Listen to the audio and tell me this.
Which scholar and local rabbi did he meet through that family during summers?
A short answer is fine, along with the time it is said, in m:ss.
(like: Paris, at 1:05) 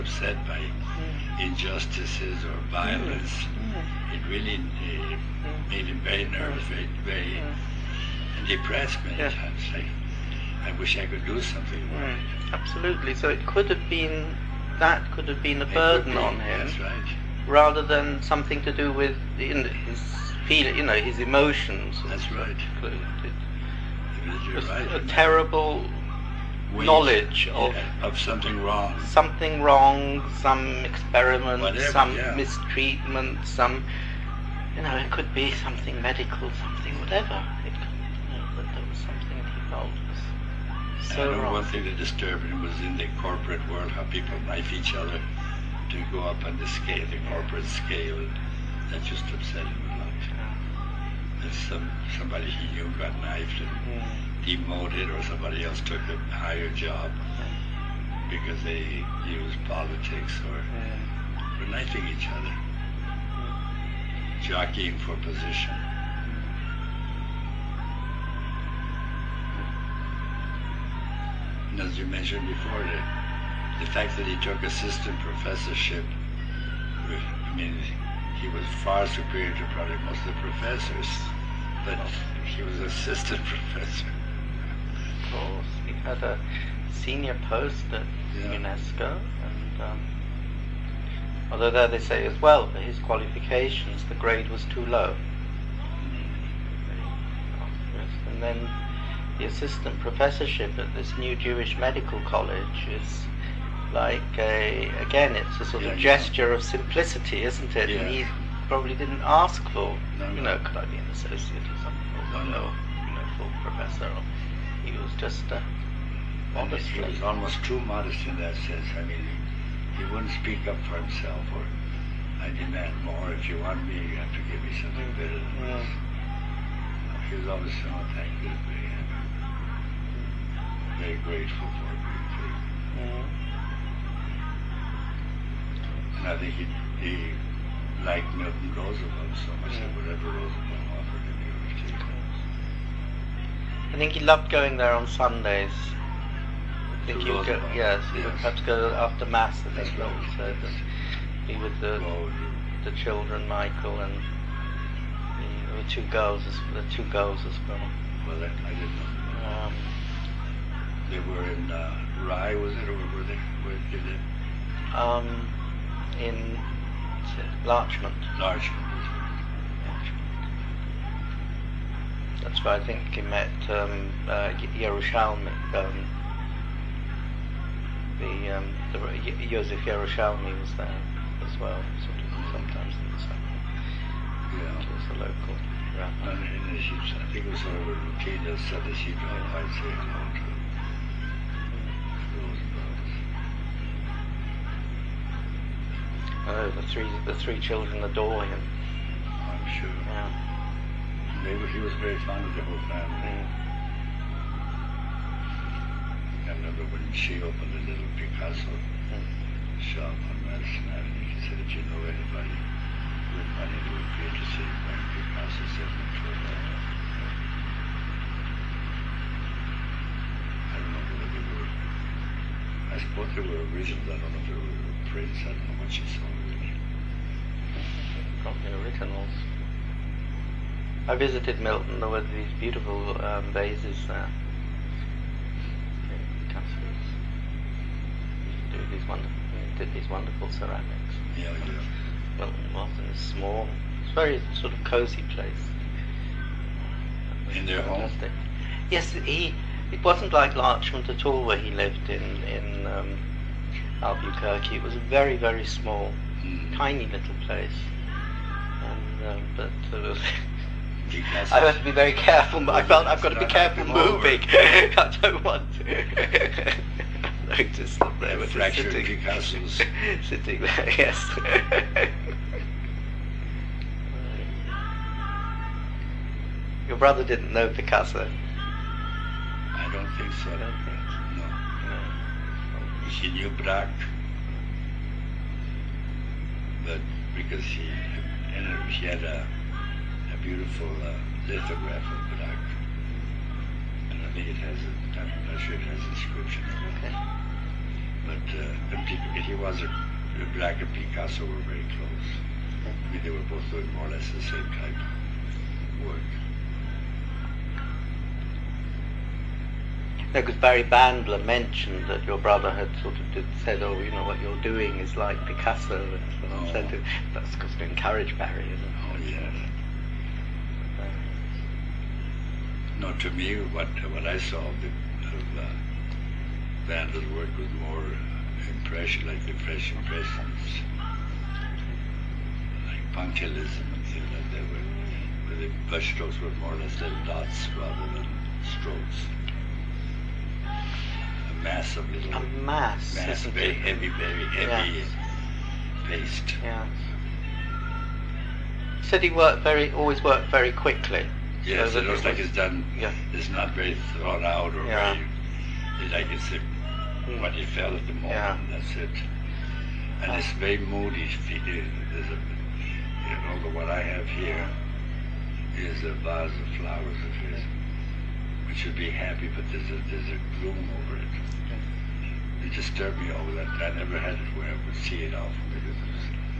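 Joseph Yerushalmi, at 2:59.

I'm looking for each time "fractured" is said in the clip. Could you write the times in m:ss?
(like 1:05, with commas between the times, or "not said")
4:28.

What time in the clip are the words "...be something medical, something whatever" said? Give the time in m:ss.
0:35.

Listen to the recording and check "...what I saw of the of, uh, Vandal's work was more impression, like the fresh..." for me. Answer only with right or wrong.
right.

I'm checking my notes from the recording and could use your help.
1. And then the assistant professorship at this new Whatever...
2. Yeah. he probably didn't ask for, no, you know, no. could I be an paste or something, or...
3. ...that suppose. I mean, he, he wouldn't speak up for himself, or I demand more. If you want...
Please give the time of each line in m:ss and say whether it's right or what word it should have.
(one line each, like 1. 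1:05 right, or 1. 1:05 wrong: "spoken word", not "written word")
1. 1:38 wrong: "Jewish", not "Whatever"
2. 1:47 wrong: "associate", not "paste"
3. 1:58 wrong: "sense", not "suppose".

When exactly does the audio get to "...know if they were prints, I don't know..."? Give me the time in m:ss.
3:44.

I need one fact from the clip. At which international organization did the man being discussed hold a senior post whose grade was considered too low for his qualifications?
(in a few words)
UNESCO.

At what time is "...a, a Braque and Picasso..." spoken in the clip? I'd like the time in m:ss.
4:59.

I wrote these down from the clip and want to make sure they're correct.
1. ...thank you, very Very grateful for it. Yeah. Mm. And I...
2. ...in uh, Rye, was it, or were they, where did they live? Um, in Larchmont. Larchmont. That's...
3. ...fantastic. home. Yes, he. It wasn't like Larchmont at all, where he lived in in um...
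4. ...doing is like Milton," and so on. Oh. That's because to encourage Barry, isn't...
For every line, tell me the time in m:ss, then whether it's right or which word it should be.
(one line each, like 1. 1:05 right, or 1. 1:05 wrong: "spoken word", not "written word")
1. 2:08 right
2. 2:41 right
3. 4:07 right
4. 5:14 wrong: "Picasso", not "Milton".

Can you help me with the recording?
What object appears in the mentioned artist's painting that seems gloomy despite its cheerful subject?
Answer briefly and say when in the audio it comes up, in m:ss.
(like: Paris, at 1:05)
vase of flowers, at 6:06.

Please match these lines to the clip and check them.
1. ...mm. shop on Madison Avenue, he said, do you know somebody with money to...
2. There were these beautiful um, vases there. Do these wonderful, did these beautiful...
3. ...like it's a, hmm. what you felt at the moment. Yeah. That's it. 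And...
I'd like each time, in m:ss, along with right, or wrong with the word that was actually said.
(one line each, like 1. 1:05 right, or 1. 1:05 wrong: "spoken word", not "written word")
1. 3:29 wrong: "anybody", not "somebody"
2. 3:51 wrong: "wonderful", not "beautiful"
3. 5:56 right.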